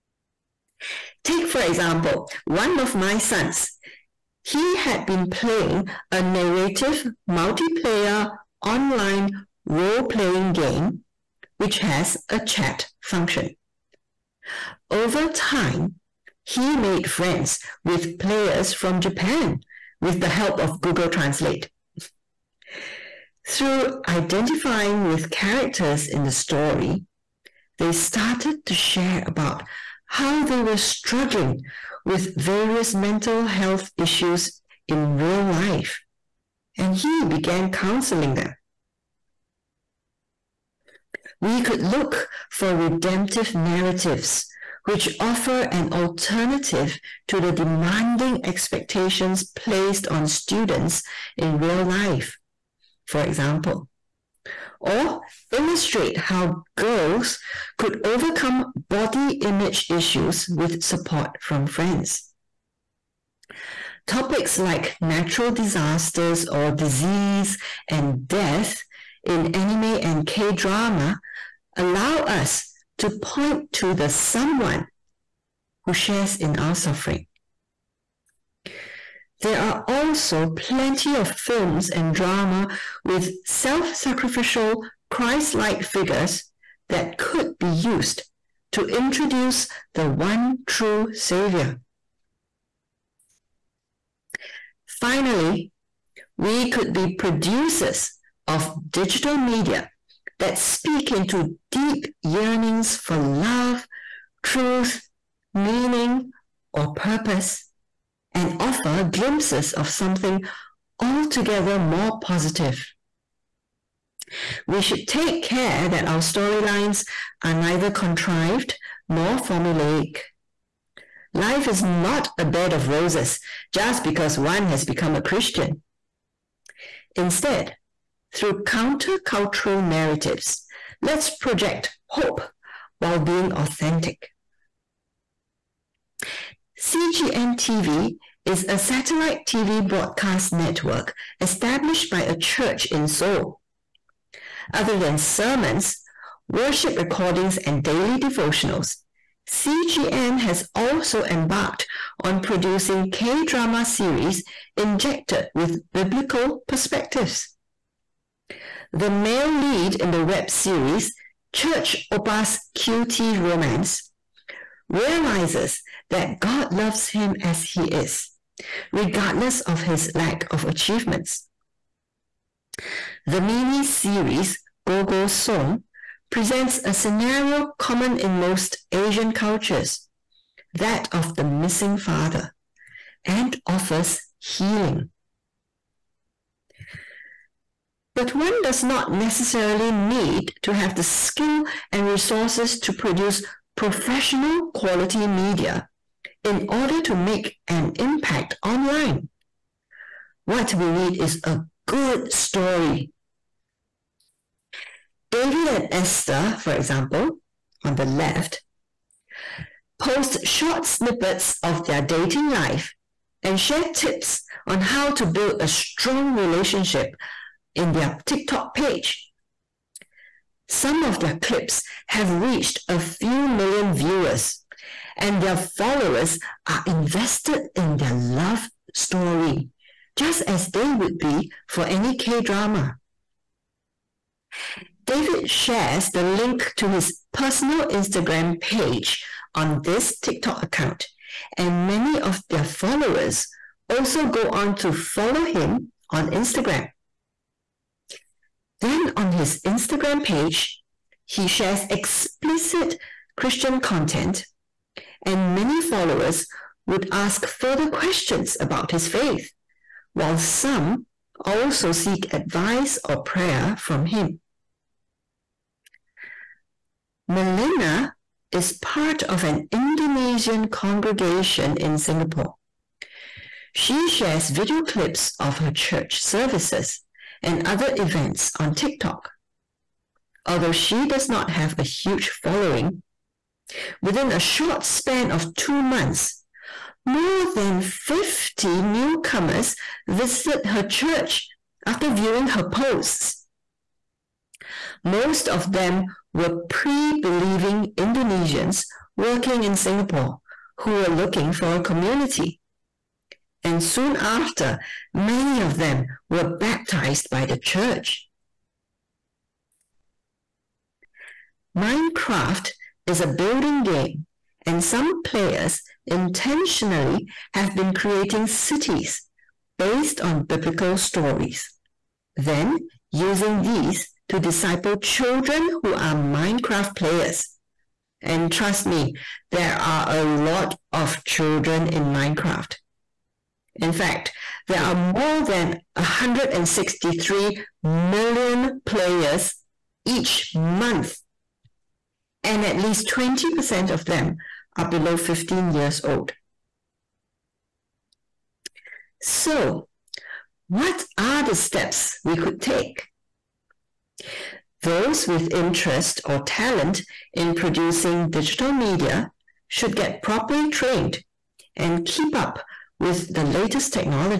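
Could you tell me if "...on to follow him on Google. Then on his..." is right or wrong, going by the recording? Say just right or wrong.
wrong.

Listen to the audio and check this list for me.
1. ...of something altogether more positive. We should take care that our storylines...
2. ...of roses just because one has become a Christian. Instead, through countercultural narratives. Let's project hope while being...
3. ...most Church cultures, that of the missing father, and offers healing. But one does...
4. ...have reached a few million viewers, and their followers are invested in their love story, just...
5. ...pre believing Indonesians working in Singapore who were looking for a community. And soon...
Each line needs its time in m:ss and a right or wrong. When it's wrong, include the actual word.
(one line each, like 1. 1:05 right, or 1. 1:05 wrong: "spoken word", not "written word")
1. 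1:49 right
2. 2:02 right
3. 2:58 wrong: "Asian", not "Church"
4. 3:42 right
5. 4:56 right.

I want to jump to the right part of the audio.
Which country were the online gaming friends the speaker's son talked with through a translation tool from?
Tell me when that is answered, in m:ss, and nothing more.
0:18.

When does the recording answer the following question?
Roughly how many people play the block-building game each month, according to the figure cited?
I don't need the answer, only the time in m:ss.
5:34.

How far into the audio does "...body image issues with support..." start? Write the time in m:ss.
0:58.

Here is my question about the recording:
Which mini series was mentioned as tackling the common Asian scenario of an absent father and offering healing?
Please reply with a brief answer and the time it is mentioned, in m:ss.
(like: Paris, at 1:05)
Go Go Song, at 2:54.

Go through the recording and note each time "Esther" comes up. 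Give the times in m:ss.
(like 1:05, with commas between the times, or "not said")
3:25.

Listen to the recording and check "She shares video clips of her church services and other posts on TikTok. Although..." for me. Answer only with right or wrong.
wrong.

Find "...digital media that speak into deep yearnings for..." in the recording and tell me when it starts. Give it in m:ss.
1:38.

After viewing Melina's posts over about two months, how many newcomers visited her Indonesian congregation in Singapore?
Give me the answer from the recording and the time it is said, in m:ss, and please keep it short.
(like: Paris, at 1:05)
more than 50, at 4:47.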